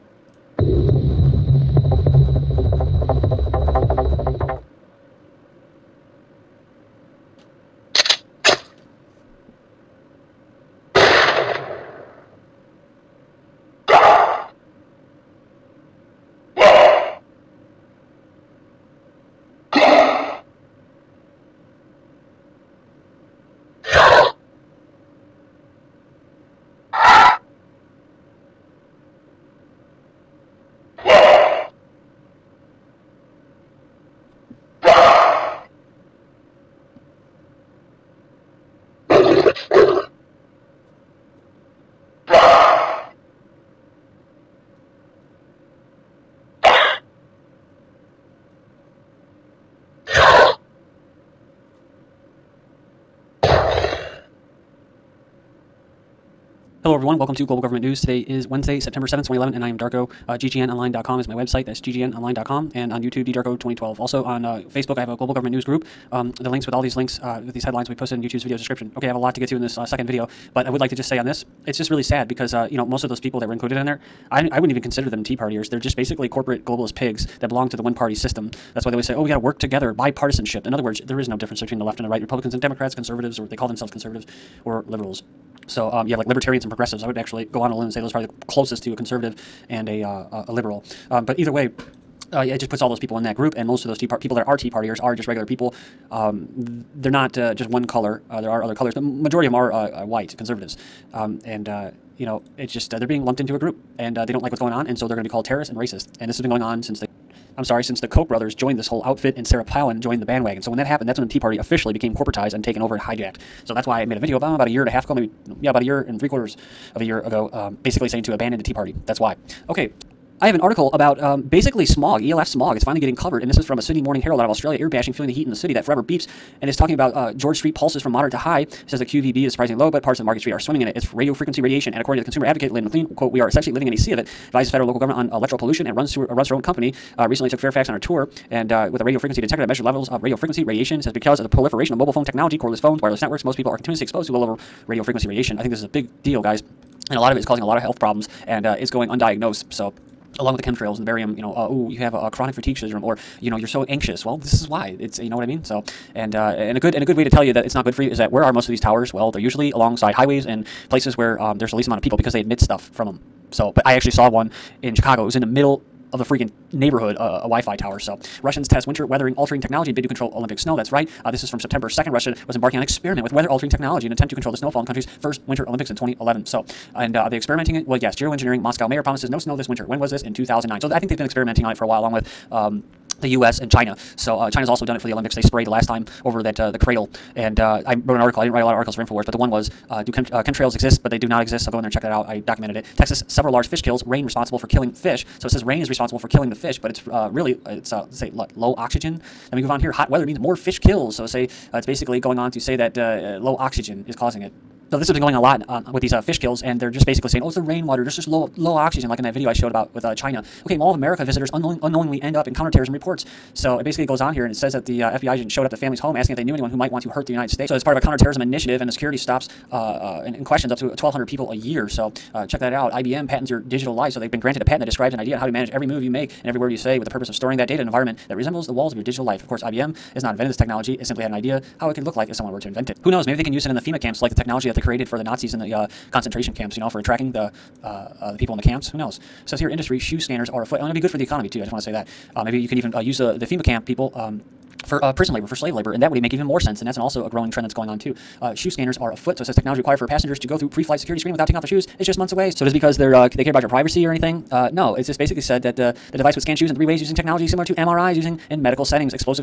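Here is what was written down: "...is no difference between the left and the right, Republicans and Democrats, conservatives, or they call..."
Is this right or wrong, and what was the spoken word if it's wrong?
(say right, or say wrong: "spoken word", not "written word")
right.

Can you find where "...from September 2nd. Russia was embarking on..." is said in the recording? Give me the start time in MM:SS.
02:51.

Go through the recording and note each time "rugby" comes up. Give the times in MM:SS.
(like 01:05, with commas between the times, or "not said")
not said.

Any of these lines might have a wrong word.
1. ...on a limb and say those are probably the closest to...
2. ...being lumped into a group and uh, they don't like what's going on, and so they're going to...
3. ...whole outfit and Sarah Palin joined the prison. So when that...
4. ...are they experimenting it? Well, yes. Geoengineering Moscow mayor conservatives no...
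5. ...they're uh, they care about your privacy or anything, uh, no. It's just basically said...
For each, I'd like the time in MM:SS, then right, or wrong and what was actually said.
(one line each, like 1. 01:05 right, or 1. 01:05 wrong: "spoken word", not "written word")
1. 01:27 right
2. 01:43 right
3. 01:48 wrong: "bandwagon", not "prison"
4. 02:57 wrong: "promises", not "conservatives"
5. 04:12 right.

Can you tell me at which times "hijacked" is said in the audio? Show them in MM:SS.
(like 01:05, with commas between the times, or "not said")
01:52.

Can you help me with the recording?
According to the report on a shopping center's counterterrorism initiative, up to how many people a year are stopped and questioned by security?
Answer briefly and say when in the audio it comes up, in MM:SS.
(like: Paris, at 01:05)
1,200, at 03:40.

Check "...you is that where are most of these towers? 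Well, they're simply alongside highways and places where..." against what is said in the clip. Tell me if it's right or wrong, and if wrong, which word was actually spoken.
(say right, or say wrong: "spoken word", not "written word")
wrong: "usually", not "simply".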